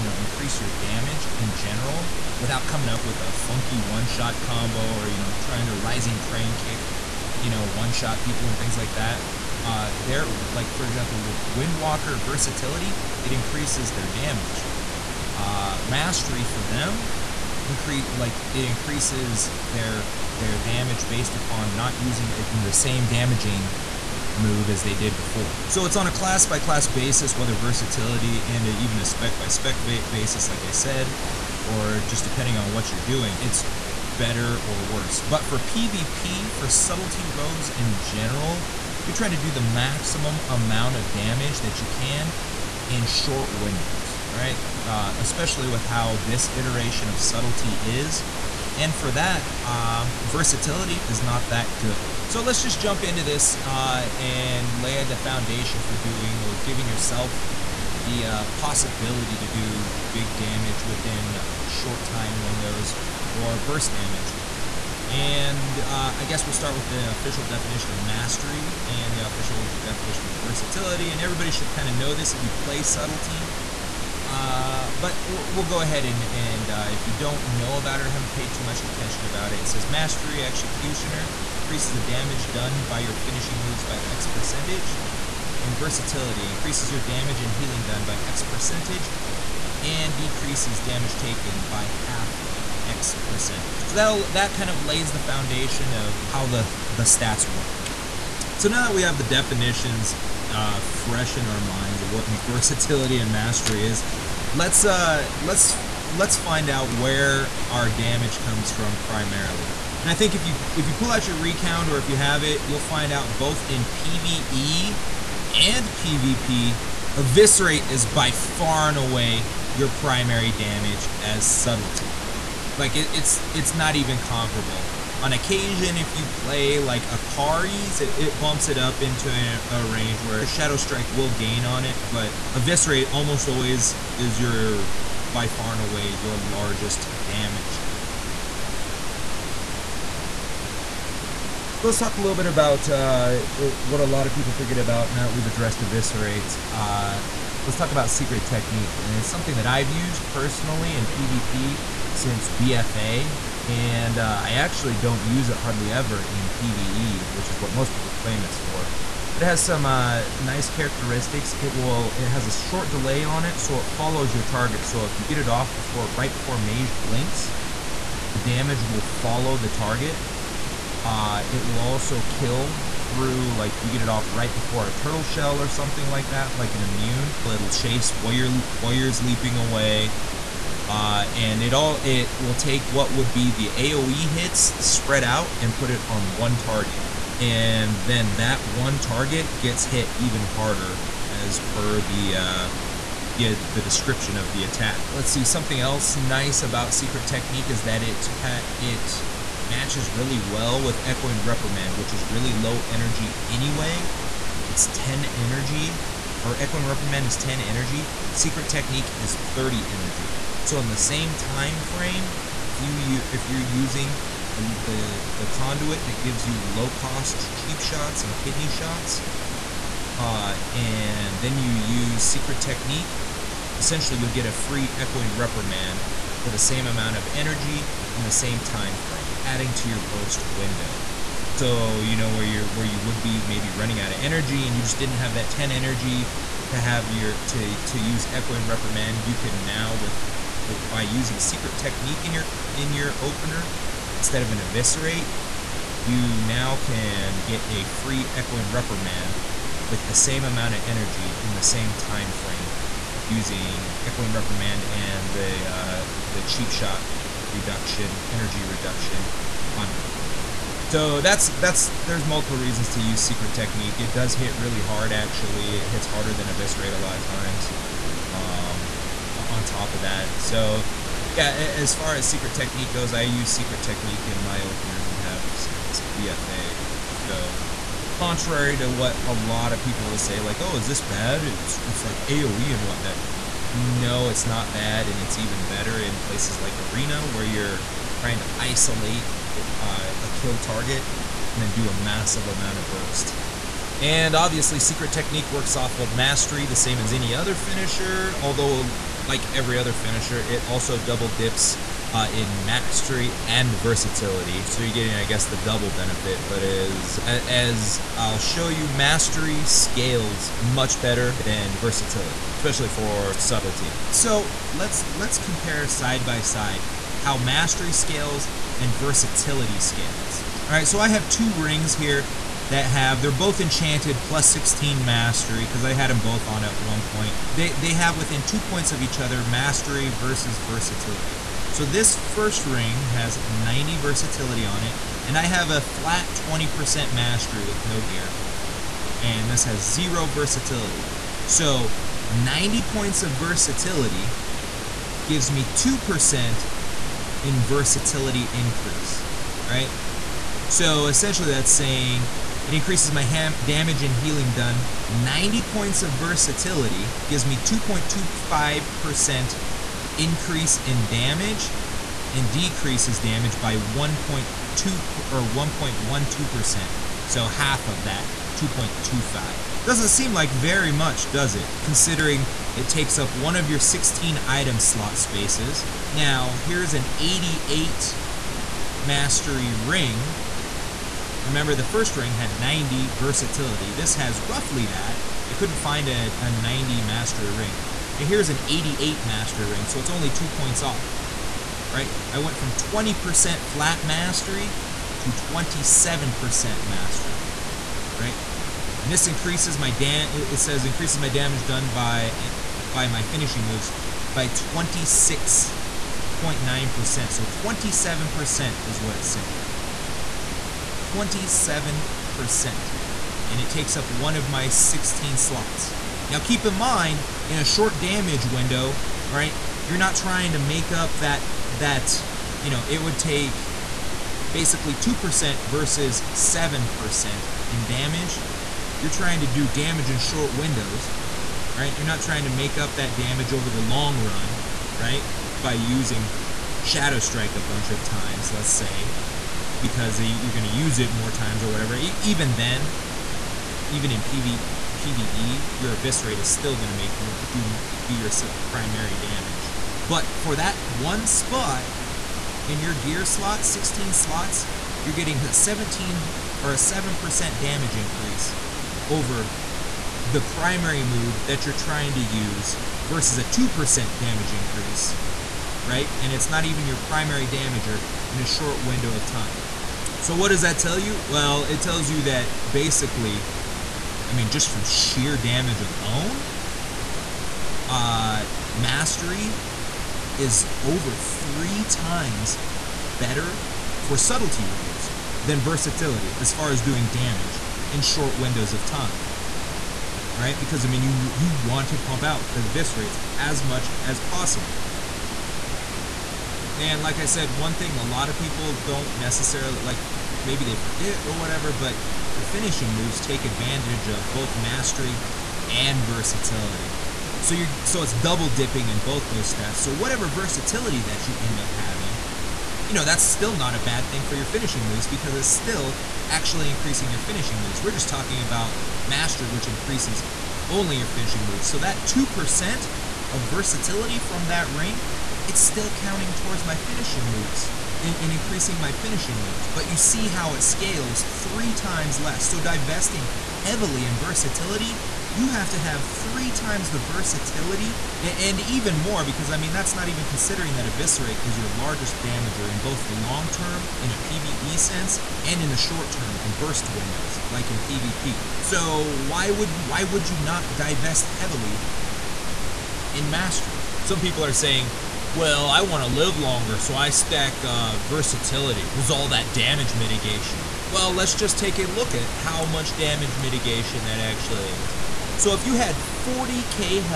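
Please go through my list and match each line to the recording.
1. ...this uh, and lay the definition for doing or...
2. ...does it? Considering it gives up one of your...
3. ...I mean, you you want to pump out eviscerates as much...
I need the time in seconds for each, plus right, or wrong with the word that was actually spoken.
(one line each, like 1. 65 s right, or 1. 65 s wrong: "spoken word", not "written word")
1. 53 s wrong: "foundation", not "definition"
2. 371 s wrong: "takes", not "gives"
3. 490 s right.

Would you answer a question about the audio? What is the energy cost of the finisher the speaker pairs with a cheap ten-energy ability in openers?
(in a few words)
30 energy.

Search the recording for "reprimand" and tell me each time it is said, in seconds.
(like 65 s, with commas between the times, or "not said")
201 s, 206 s, 225 s, 238 s, 248 s, 254 s.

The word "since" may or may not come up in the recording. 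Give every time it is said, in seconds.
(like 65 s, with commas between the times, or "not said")
152 s, 275 s.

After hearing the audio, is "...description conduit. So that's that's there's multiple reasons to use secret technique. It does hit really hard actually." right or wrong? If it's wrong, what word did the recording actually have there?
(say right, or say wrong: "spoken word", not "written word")
wrong: "reduction", not "description".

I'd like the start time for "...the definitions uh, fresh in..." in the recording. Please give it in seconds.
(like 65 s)
99 s.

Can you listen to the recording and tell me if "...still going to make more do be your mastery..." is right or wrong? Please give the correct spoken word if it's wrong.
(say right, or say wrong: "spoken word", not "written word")
wrong: "primary", not "mastery".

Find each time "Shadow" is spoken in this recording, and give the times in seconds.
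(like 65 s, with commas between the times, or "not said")
130 s, 436 s.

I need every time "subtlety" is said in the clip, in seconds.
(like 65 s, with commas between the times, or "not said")
36 s, 47 s, 72 s, 121 s, 313 s, 484 s.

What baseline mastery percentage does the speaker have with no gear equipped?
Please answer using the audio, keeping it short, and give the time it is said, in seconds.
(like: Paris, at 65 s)
20%, at 336 s.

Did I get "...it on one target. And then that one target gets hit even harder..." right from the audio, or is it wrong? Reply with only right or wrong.
right.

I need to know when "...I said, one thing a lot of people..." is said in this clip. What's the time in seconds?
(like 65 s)
497 s.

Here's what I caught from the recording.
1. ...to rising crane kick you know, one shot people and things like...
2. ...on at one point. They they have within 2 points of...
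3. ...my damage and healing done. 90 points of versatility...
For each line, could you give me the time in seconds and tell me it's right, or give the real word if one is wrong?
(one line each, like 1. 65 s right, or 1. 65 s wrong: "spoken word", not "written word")
1. 5 s right
2. 326 s right
3. 353 s right.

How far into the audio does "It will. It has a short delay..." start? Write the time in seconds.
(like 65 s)
161 s.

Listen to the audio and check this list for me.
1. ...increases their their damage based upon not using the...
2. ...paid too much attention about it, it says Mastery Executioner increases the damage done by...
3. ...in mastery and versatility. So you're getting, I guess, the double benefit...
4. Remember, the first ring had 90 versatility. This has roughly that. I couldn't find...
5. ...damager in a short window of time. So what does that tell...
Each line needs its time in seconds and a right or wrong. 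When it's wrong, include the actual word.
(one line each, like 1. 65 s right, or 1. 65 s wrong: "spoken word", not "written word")
1. 18 s right
2. 78 s right
3. 302 s right
4. 381 s right
5. 467 s right.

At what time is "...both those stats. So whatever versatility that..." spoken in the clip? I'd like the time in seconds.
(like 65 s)
508 s.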